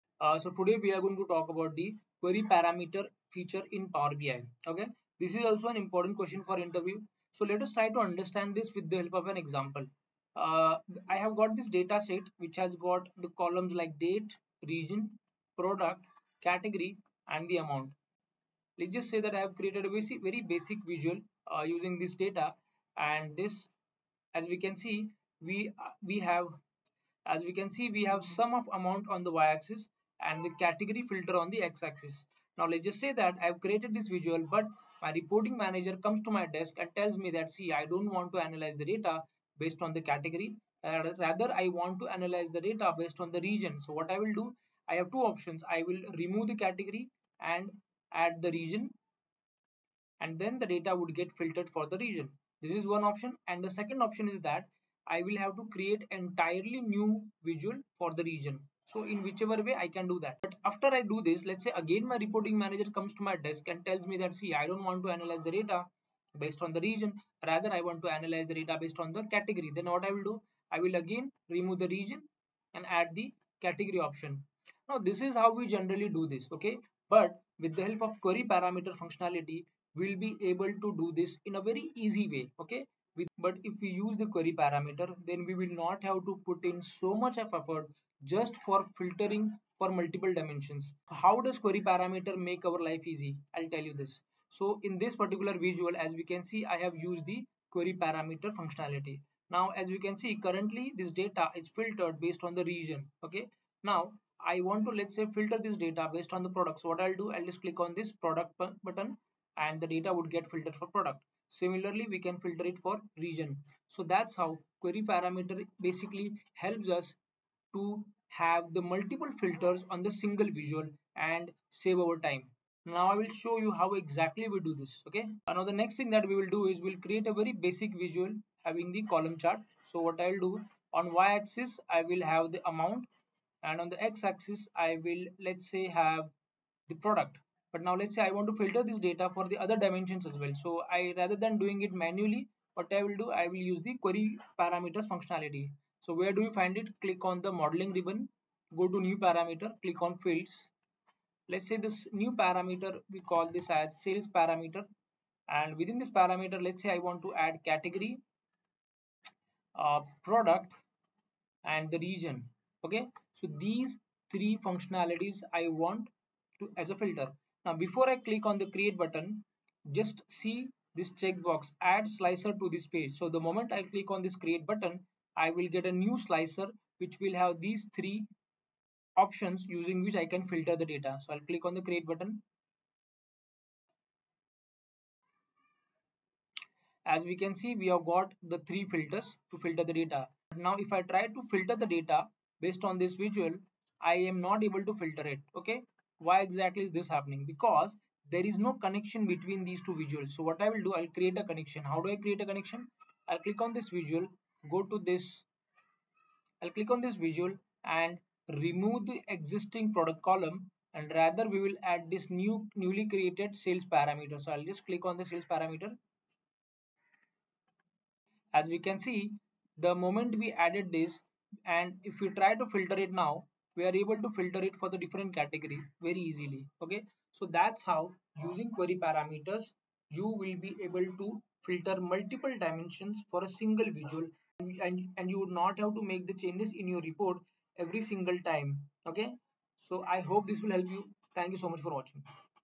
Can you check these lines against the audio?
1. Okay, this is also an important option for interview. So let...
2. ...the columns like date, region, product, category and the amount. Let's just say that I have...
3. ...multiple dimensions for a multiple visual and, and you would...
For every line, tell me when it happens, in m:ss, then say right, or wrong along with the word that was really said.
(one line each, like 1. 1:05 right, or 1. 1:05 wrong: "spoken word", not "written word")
1. 0:04 wrong: "question", not "option"
2. 0:13 right
3. 3:52 wrong: "single", not "multiple".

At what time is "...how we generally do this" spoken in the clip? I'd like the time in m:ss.
1:15.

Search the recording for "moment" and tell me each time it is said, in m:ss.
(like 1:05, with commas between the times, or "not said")
2:53, 3:40.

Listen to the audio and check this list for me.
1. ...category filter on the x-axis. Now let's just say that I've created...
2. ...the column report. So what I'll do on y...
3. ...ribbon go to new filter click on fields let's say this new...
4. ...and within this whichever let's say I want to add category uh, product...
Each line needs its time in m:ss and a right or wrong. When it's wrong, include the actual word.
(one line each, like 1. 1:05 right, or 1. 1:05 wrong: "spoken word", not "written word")
1. 0:30 right
2. 2:08 wrong: "chart", not "report"
3. 2:27 wrong: "parameter", not "filter"
4. 2:35 wrong: "parameter", not "whichever".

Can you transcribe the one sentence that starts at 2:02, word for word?
Now I will show you how exactly we do this.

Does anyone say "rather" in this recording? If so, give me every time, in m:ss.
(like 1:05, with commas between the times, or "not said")
0:41, 1:07, 2:21, 3:31.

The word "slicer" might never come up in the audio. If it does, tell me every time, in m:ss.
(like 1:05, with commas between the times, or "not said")
2:52, 2:56.